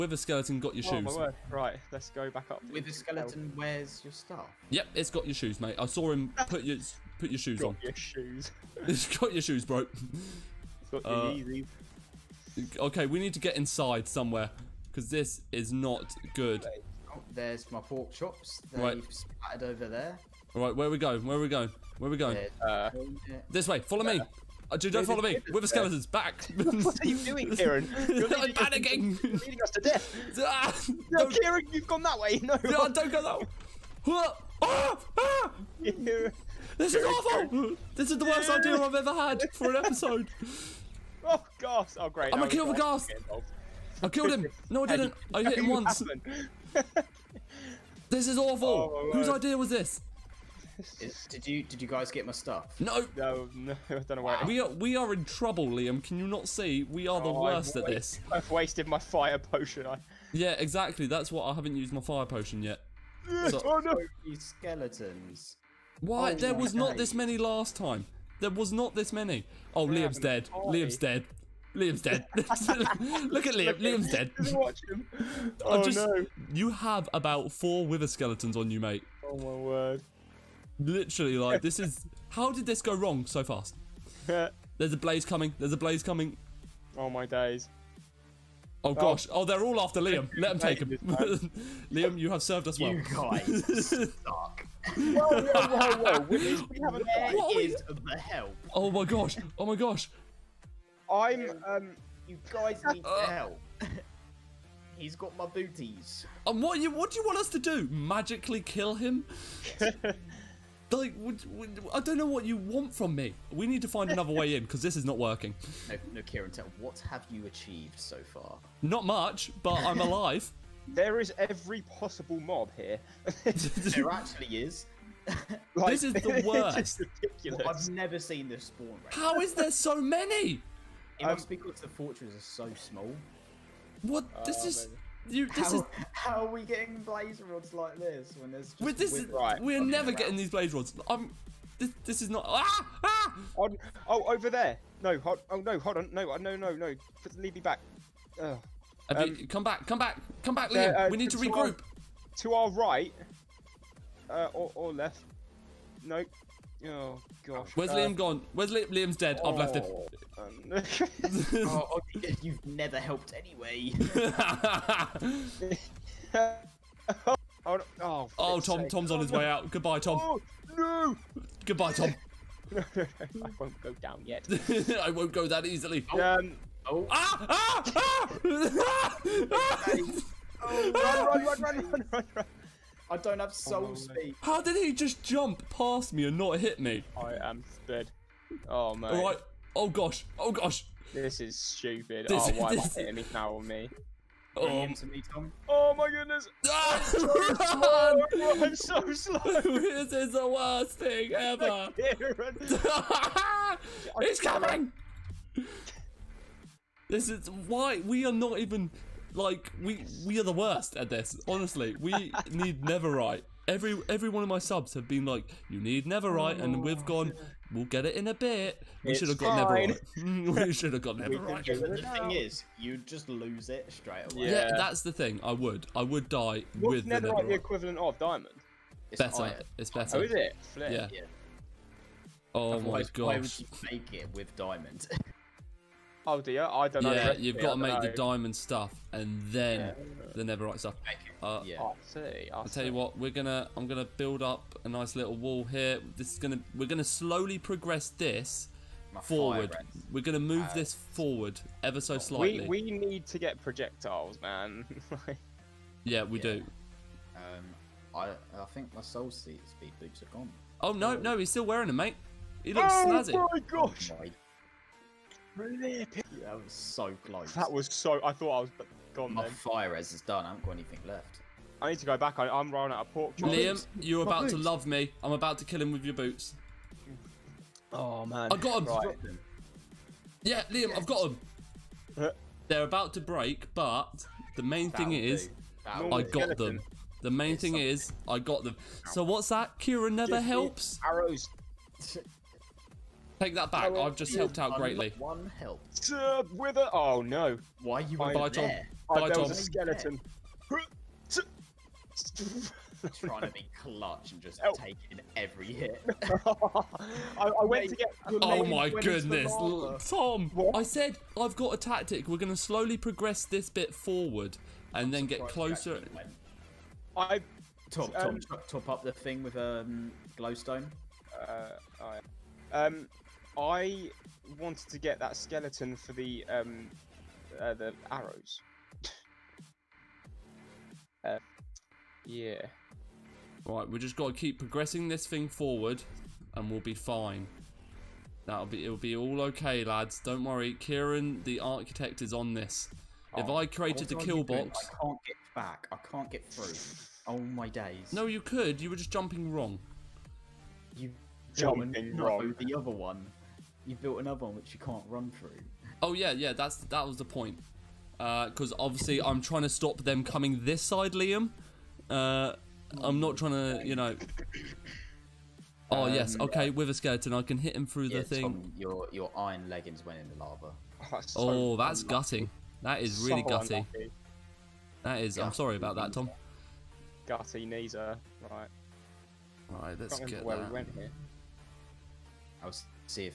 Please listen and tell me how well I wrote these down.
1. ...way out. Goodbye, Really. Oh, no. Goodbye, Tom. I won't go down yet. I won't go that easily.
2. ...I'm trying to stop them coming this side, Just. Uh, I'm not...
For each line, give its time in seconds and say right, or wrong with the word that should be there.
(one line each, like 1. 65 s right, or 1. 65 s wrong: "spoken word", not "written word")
1. 169 s wrong: "Tom", not "Really"
2. 359 s wrong: "Liam", not "Just".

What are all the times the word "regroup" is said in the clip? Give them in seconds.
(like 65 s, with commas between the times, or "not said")
151 s.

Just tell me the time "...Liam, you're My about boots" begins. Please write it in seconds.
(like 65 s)
273 s.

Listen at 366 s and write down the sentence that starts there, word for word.
With a skeleton, I can hit him through yeah, the thing.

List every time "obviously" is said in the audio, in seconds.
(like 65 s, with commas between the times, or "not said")
358 s.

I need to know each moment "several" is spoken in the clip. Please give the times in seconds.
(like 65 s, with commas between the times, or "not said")
not said.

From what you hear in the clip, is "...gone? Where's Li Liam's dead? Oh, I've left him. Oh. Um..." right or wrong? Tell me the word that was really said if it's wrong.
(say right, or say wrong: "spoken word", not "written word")
right.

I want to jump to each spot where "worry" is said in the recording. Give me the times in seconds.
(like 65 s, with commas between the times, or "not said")
340 s.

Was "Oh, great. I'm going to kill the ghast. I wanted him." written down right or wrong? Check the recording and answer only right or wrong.
wrong.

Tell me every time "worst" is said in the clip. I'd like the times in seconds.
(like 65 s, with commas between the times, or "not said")
38 s, 57 s, 126 s, 200 s, 210 s.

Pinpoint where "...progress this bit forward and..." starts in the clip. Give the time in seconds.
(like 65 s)
312 s.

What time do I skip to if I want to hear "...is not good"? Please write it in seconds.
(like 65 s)
15 s.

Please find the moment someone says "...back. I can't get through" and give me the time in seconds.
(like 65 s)
345 s.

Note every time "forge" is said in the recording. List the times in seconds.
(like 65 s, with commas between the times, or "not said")
not said.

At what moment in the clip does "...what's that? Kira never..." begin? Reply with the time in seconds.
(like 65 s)
289 s.